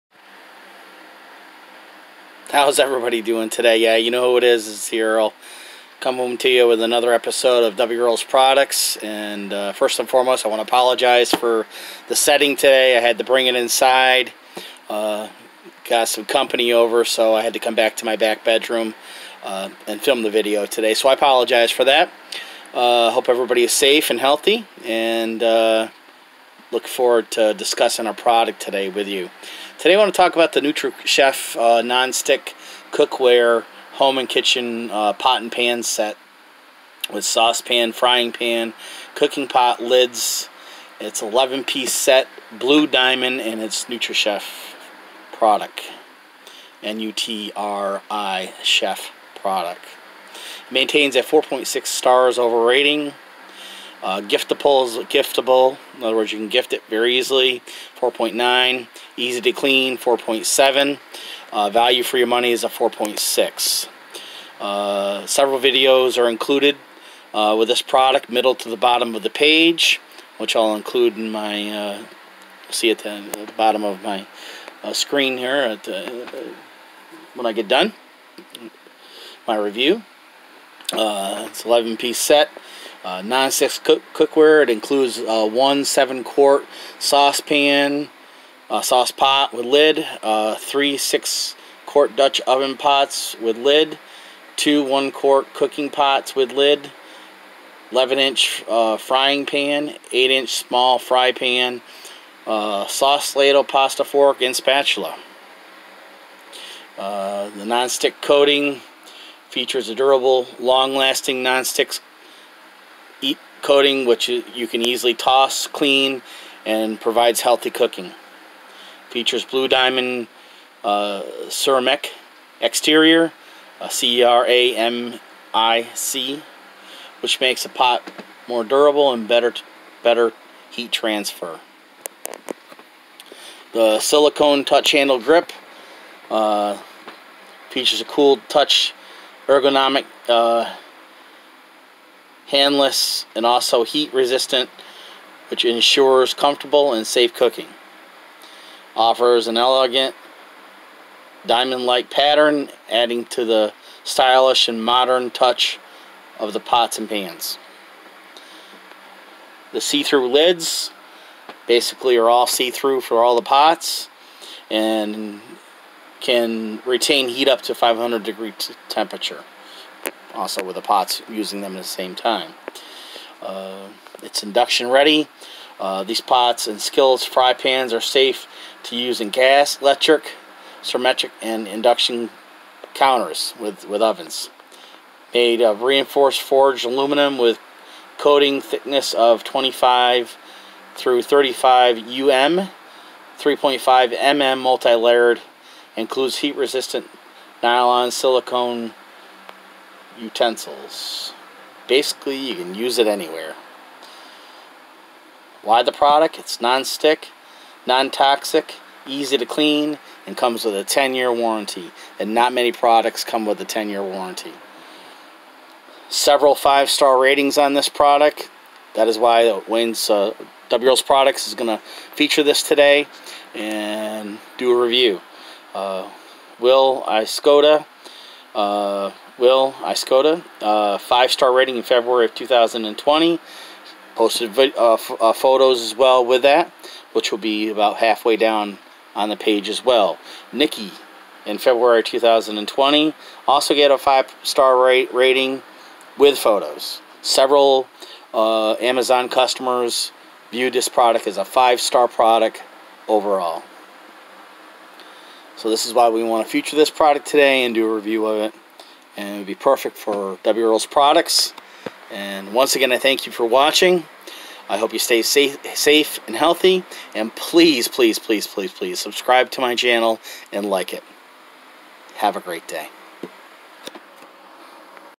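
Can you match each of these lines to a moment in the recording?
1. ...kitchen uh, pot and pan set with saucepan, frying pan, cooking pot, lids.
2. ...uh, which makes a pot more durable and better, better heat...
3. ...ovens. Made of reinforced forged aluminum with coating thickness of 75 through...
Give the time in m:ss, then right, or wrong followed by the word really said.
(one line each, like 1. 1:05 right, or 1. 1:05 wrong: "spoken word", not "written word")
1. 0:34 right
2. 2:06 right
3. 3:04 wrong: "25", not "75".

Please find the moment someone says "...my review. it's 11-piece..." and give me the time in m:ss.
1:19.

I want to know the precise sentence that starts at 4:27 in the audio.
And please, please, please, please, please subscribe to my channel and like it.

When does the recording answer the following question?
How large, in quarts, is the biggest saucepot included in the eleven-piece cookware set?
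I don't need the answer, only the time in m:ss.
1:25.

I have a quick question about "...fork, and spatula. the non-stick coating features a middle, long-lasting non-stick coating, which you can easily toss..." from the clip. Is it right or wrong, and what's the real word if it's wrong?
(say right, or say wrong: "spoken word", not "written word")
wrong: "durable", not "middle".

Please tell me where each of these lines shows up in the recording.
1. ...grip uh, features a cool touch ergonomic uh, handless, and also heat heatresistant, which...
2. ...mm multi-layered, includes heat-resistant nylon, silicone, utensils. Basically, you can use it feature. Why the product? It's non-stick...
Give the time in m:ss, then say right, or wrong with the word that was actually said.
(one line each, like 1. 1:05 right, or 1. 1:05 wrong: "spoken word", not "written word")
1. 2:15 wrong: "resistant", not "heatresistant"
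2. 3:14 wrong: "anywhere", not "feature".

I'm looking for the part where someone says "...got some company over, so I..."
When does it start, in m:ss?
0:15.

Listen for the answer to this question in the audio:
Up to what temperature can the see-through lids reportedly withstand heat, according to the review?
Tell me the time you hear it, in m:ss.
2:47.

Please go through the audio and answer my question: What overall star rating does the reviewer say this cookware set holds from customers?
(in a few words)
4.6 stars.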